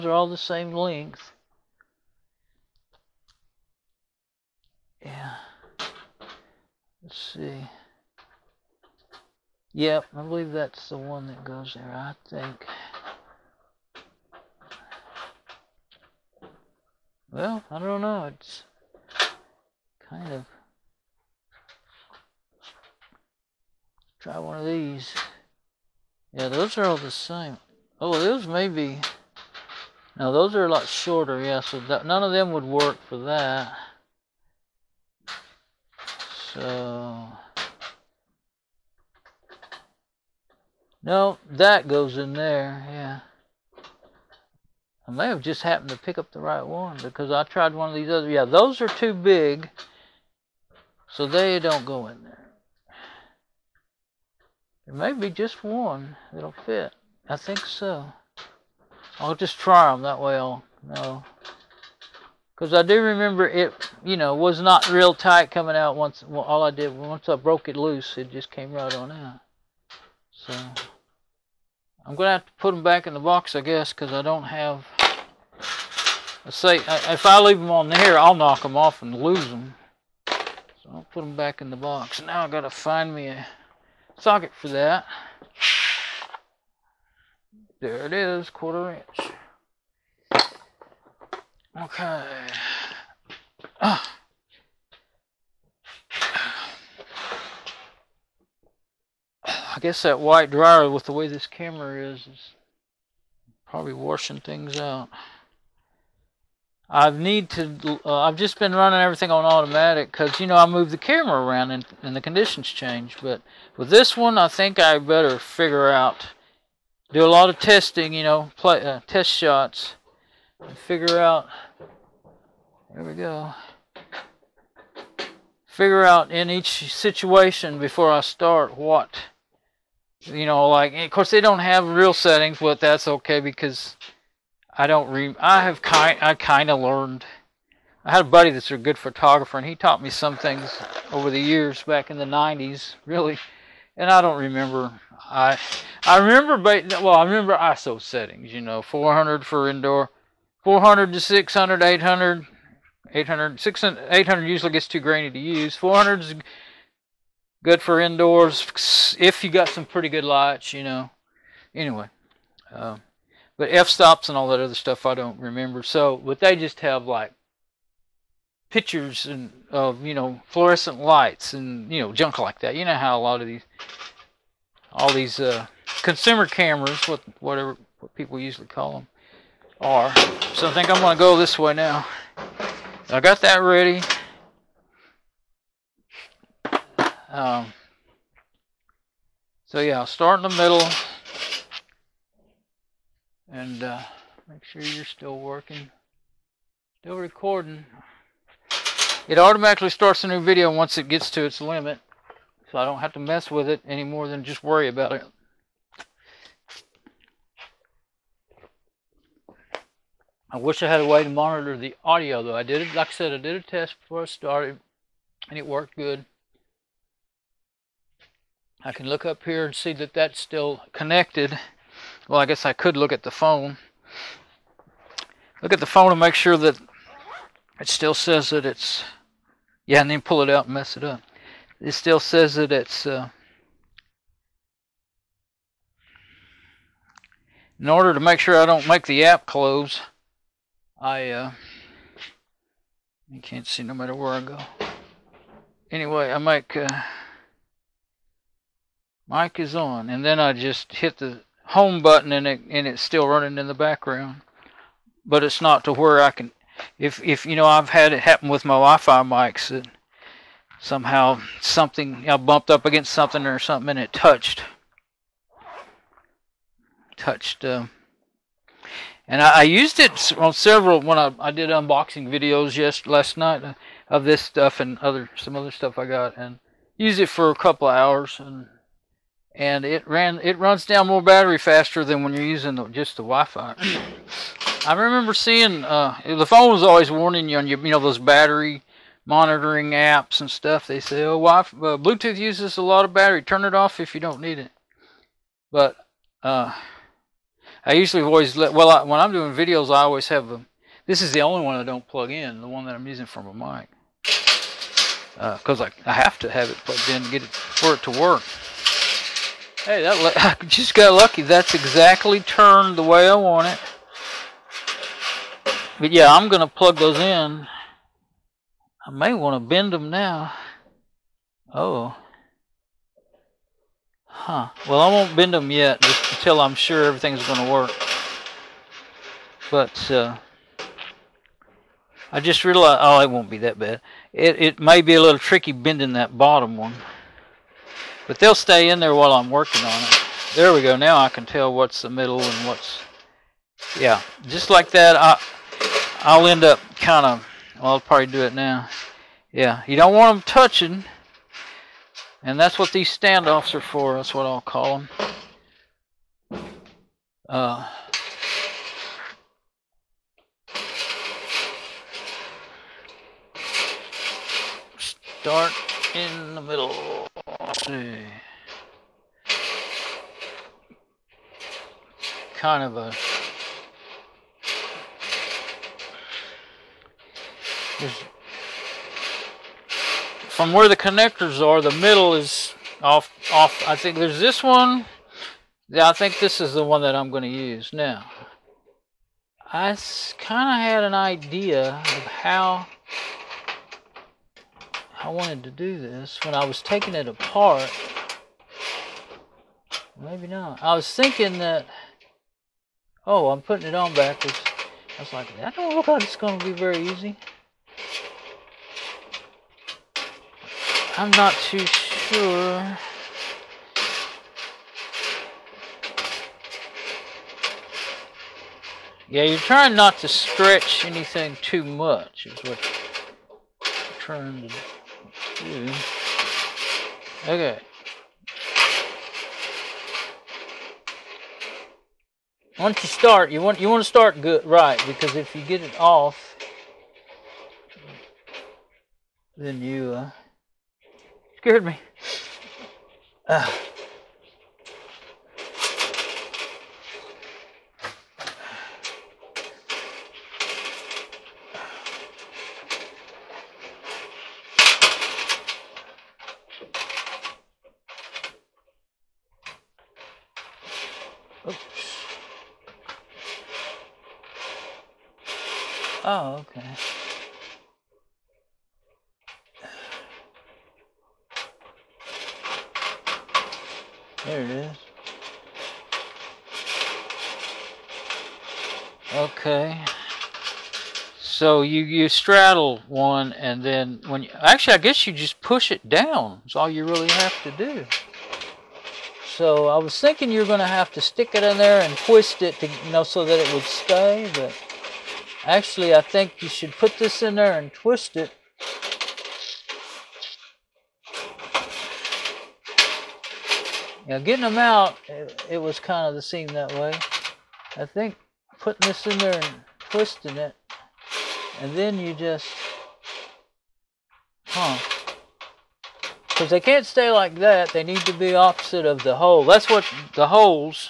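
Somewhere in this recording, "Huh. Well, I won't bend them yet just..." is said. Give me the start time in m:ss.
5:24.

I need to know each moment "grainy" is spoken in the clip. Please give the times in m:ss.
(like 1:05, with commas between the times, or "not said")
2:34.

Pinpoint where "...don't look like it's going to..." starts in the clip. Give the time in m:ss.
6:45.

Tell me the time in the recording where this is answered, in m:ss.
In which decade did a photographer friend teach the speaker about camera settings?
2:22.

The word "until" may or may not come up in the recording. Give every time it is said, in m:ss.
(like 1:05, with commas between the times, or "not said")
5:26.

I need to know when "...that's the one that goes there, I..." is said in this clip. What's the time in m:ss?
0:10.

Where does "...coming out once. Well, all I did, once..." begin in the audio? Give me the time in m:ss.
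1:05.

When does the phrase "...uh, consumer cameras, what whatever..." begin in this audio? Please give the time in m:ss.
2:55.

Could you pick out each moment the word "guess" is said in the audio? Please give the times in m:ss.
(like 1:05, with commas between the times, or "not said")
1:13, 1:39, 3:42, 8:04.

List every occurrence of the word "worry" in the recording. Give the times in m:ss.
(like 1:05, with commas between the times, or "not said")
3:24.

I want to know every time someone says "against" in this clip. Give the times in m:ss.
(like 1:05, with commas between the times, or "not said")
4:22.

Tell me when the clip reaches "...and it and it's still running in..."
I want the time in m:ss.
4:12.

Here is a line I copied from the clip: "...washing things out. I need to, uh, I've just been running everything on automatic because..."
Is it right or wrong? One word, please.
right.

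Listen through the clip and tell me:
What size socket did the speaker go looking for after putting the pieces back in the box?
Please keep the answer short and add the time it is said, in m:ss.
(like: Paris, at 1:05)
quarter inch, at 1:28.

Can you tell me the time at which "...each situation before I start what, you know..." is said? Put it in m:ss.
2:06.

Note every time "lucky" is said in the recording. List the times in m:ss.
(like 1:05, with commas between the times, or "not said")
5:11.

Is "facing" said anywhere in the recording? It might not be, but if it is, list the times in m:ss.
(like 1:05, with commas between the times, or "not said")
not said.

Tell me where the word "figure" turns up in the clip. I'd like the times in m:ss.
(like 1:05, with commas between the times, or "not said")
1:55, 2:00, 2:05.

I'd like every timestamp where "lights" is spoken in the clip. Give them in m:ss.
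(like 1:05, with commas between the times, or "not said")
2:40, 2:50.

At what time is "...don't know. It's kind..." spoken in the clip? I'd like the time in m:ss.
0:17.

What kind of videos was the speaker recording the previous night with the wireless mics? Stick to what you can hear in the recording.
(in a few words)
unboxing videos.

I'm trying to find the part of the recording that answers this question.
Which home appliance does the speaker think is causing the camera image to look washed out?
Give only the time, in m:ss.
1:40.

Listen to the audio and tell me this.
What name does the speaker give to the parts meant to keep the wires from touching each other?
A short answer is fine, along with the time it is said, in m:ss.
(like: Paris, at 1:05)
standoffs, at 5:53.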